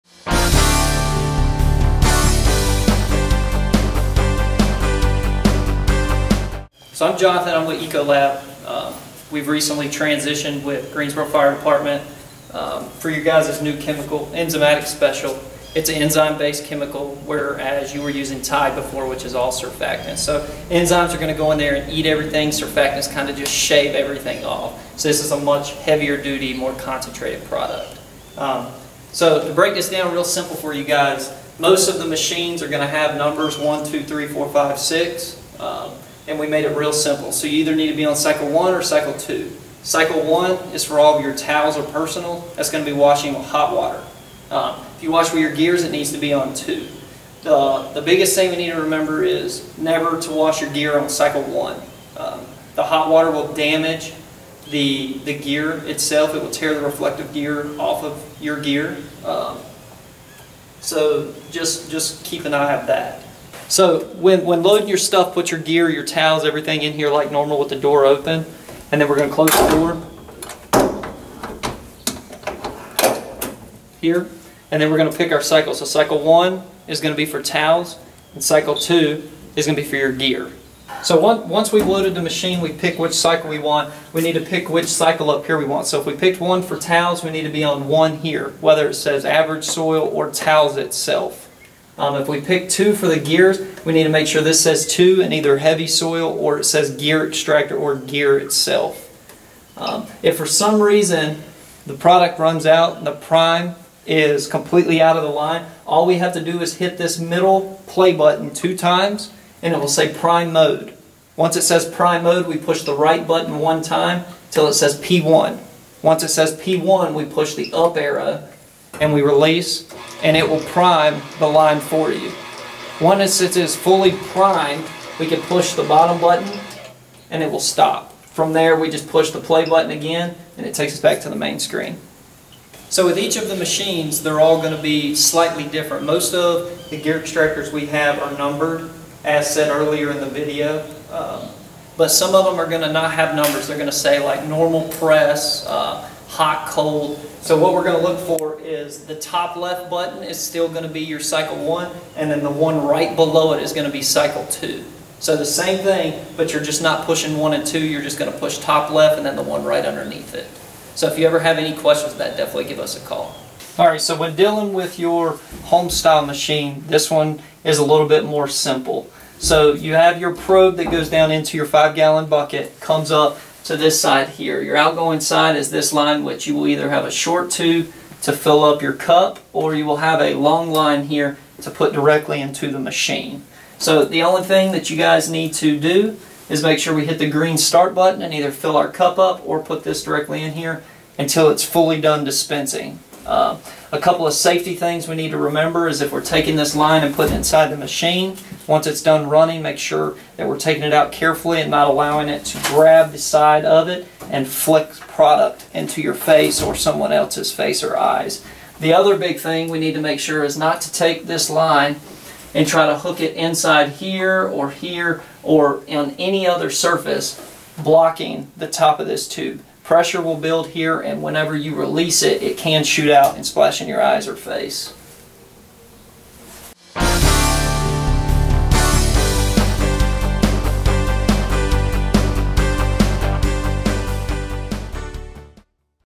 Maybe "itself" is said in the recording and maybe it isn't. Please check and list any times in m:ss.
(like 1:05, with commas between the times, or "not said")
0:55, 1:30, 1:38.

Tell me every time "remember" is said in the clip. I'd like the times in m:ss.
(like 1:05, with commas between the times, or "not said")
0:48, 3:15.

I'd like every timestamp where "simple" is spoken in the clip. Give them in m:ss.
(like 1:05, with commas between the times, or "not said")
0:30, 0:36, 2:48.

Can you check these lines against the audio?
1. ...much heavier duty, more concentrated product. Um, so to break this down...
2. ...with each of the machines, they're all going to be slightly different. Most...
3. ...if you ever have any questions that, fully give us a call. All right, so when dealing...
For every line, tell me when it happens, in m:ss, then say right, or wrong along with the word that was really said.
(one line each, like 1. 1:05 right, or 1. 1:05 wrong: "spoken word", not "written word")
1. 0:25 right
2. 2:13 right
3. 2:41 wrong: "definitely", not "fully".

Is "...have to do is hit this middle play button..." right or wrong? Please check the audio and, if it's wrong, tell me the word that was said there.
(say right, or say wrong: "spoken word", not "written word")
right.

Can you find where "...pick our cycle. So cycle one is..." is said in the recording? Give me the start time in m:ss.
1:15.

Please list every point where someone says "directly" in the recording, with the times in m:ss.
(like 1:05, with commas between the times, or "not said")
3:01, 3:10.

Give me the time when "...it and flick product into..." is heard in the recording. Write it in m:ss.
3:23.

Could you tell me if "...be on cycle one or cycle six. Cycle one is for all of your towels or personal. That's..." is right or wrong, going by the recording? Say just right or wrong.
wrong.